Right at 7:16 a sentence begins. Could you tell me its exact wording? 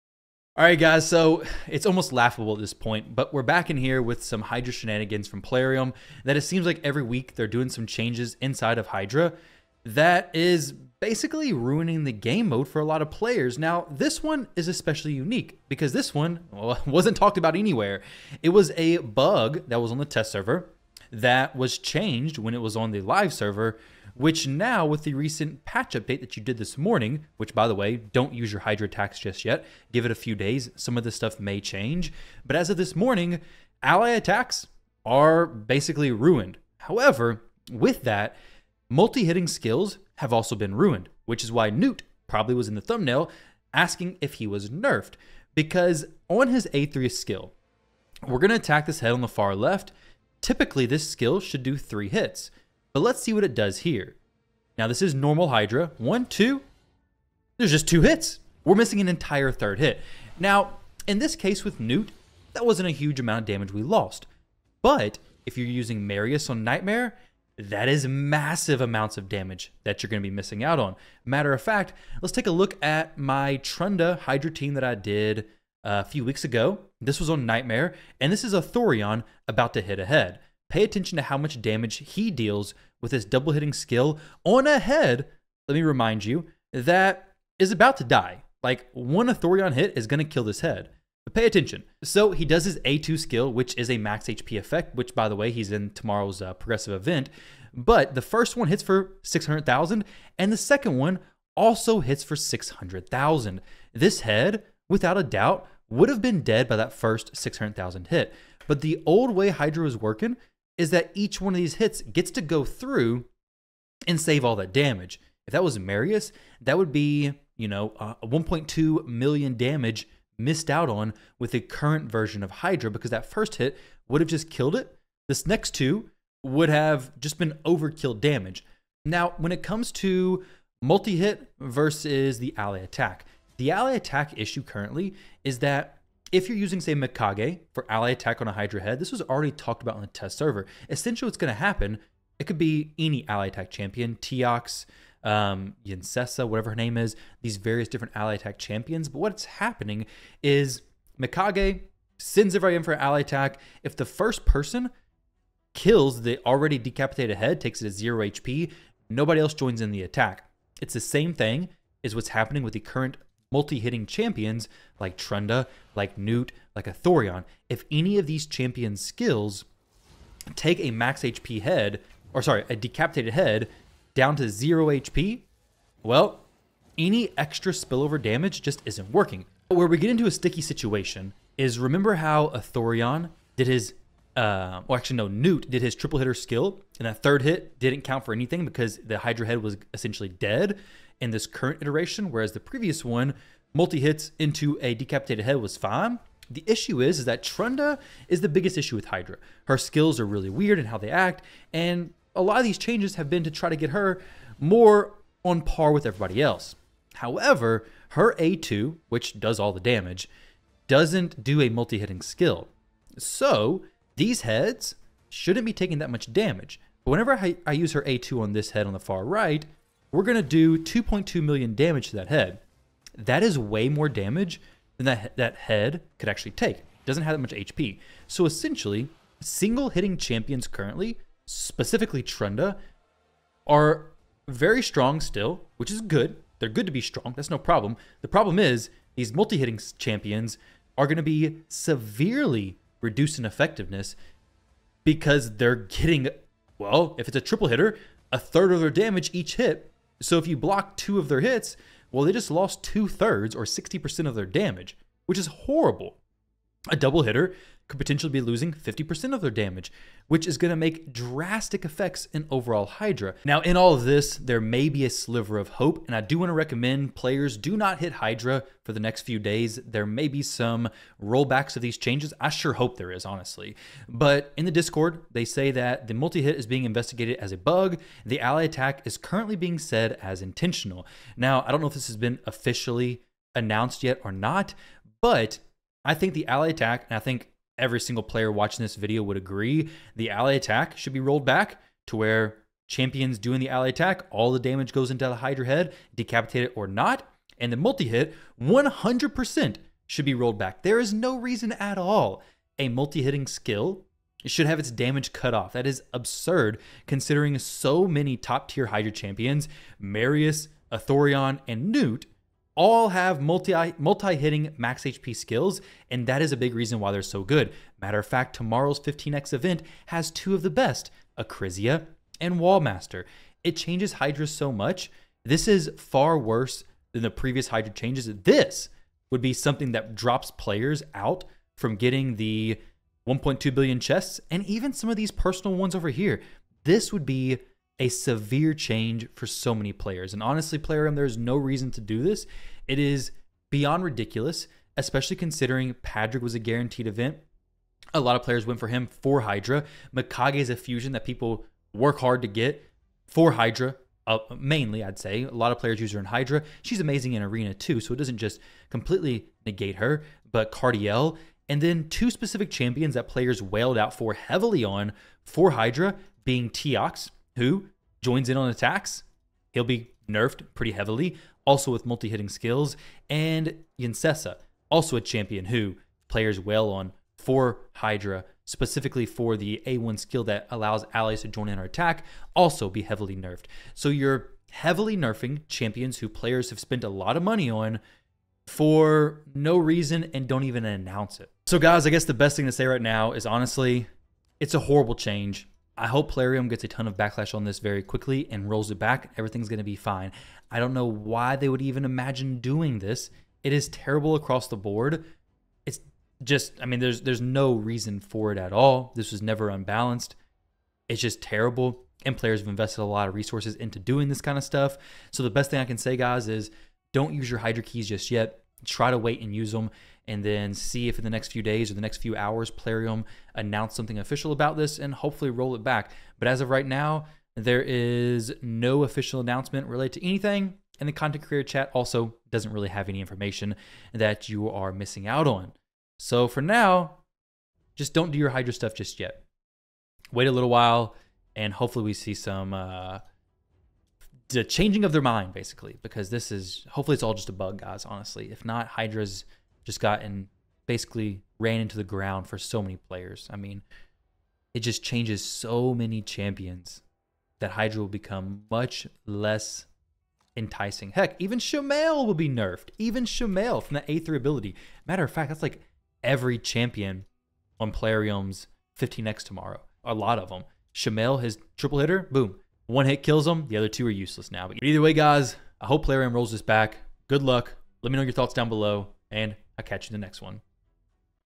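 So for now, just don't do your Hydra stuff just yet.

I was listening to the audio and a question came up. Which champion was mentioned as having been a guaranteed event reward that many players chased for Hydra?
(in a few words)
Patrick.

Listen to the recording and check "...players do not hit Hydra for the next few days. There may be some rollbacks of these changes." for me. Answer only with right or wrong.
right.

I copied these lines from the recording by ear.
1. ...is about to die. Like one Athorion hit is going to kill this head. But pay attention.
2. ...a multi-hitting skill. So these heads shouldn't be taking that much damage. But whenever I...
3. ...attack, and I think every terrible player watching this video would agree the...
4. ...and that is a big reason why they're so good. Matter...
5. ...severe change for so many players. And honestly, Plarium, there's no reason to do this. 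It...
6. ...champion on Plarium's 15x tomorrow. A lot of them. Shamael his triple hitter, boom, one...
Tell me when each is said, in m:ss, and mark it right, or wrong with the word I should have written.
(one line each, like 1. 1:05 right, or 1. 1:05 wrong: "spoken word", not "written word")
1. 1:27 right
2. 3:31 right
3. 4:46 wrong: "single", not "terrible"
4. 5:16 right
5. 5:38 right
6. 7:46 right.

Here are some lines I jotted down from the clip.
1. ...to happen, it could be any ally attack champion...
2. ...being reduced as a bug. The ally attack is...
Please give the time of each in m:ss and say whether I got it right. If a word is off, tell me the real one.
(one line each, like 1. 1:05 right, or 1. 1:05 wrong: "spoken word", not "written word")
1. 2:21 right
2. 4:36 wrong: "investigated", not "reduced".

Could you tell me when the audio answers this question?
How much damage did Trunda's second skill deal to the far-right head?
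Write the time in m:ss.
3:40.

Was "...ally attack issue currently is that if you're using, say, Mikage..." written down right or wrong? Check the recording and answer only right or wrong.
right.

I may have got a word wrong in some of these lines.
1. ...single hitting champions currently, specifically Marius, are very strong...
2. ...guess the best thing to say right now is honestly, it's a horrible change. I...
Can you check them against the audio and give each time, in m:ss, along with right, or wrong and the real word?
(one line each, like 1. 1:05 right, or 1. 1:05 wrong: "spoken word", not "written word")
1. 3:49 wrong: "Trunda", not "Marius"
2. 6:32 right.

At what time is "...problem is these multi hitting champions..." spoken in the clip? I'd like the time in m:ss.
3:58.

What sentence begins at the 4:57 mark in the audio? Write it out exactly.
And the multi hit, 100% should be rolled back.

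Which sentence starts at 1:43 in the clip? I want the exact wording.
This head, without a doubt, would have been dead by that first 600,000 hit.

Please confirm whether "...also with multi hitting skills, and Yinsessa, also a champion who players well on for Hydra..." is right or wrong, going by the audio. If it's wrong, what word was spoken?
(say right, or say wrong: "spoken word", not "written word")
right.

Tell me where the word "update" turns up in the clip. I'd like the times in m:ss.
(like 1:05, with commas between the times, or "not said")
0:25.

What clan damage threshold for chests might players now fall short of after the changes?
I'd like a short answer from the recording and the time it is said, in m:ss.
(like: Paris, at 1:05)
1.2 billion, at 5:33.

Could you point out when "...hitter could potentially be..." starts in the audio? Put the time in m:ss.
4:17.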